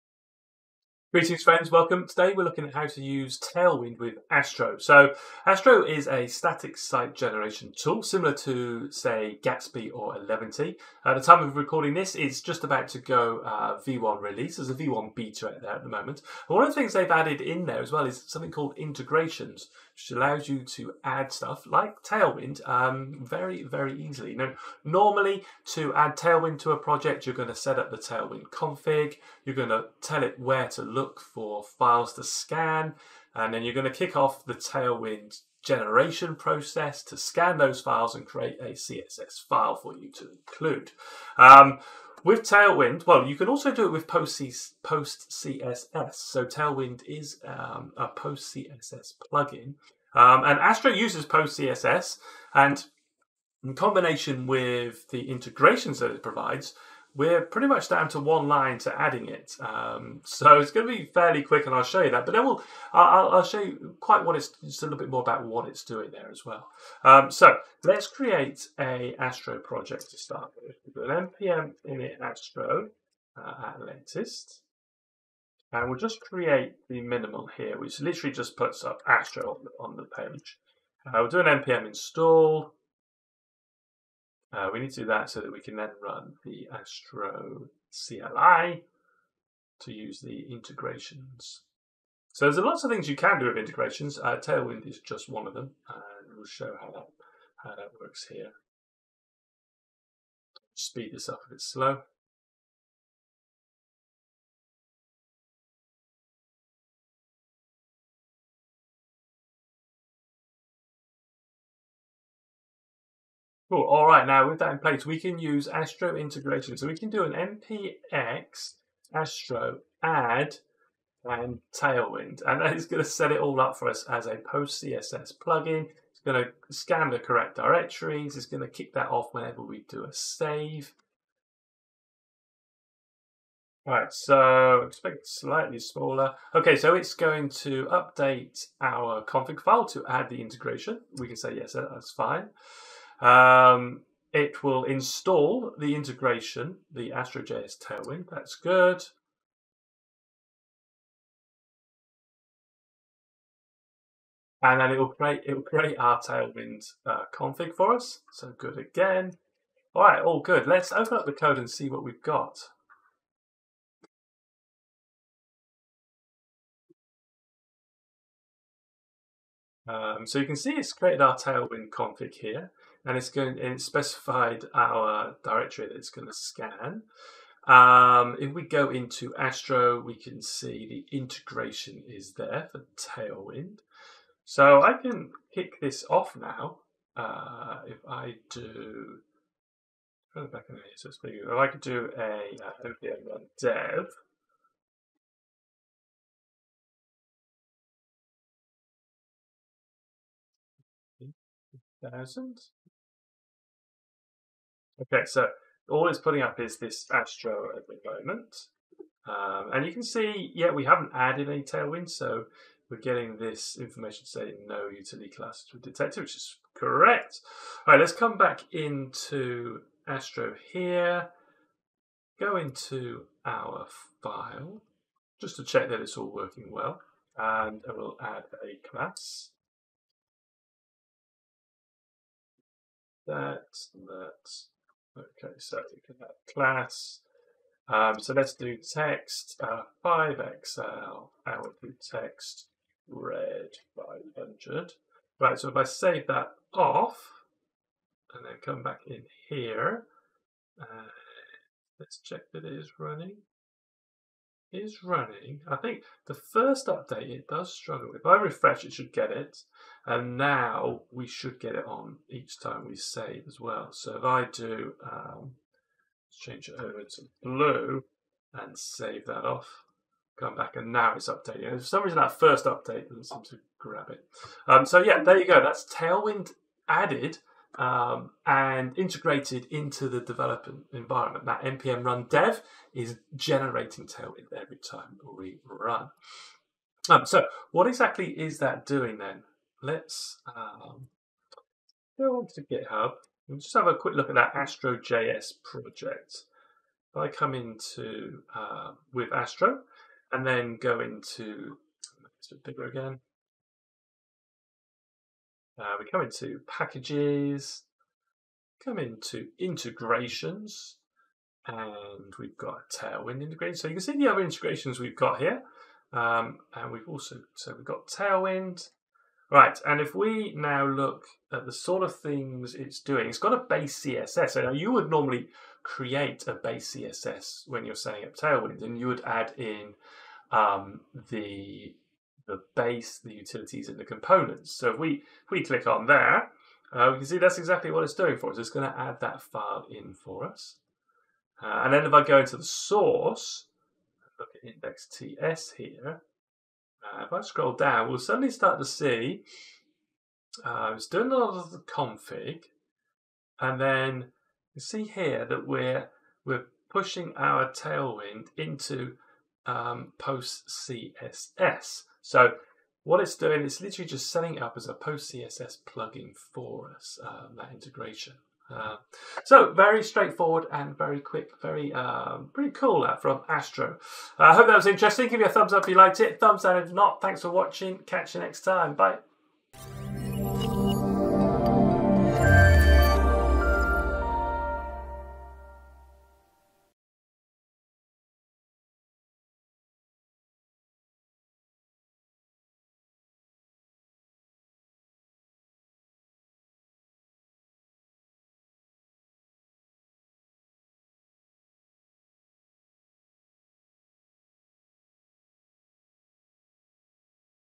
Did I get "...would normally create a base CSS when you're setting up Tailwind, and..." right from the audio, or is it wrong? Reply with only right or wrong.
right.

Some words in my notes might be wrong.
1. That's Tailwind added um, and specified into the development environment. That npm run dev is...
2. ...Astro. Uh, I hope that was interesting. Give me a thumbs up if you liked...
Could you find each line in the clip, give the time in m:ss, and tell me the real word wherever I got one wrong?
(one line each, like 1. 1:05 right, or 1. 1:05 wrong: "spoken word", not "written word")
1. 4:35 wrong: "integrated", not "specified"
2. 6:13 right.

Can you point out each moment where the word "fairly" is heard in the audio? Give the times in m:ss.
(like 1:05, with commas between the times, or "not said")
1:01.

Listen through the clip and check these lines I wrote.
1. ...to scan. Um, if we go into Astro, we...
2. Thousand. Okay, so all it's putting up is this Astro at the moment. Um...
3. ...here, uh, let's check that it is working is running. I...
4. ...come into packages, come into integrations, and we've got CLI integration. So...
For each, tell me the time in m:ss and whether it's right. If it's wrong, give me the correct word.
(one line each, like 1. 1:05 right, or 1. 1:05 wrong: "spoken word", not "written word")
1. 2:56 right
2. 3:22 right
3. 4:09 wrong: "running", not "working"
4. 5:06 wrong: "Tailwind", not "CLI".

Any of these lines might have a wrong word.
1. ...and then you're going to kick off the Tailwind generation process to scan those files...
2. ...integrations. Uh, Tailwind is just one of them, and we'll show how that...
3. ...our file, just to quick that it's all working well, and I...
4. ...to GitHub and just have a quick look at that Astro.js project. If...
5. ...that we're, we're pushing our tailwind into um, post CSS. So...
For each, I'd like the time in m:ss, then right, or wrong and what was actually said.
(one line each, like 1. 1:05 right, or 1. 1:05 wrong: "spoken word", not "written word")
1. 0:33 right
2. 1:33 right
3. 3:43 wrong: "check", not "quick"
4. 4:52 right
5. 5:55 right.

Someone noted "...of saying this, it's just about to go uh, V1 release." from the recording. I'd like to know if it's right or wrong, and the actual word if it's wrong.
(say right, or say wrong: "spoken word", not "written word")
wrong: "recording", not "saying".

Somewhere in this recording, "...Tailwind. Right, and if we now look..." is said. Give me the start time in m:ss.
5:18.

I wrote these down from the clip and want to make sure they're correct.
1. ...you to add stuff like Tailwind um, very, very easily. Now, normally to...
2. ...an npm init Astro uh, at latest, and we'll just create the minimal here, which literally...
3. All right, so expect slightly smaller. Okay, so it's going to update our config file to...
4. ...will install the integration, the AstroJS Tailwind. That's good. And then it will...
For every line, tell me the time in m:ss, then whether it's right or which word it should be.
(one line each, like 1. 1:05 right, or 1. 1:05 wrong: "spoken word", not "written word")
1. 0:20 right
2. 1:11 right
3. 2:13 right
4. 2:24 right.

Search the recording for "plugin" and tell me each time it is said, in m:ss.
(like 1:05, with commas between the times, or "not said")
0:49, 2:05, 6:05.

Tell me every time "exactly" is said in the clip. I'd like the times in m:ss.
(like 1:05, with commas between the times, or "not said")
4:47, 5:37.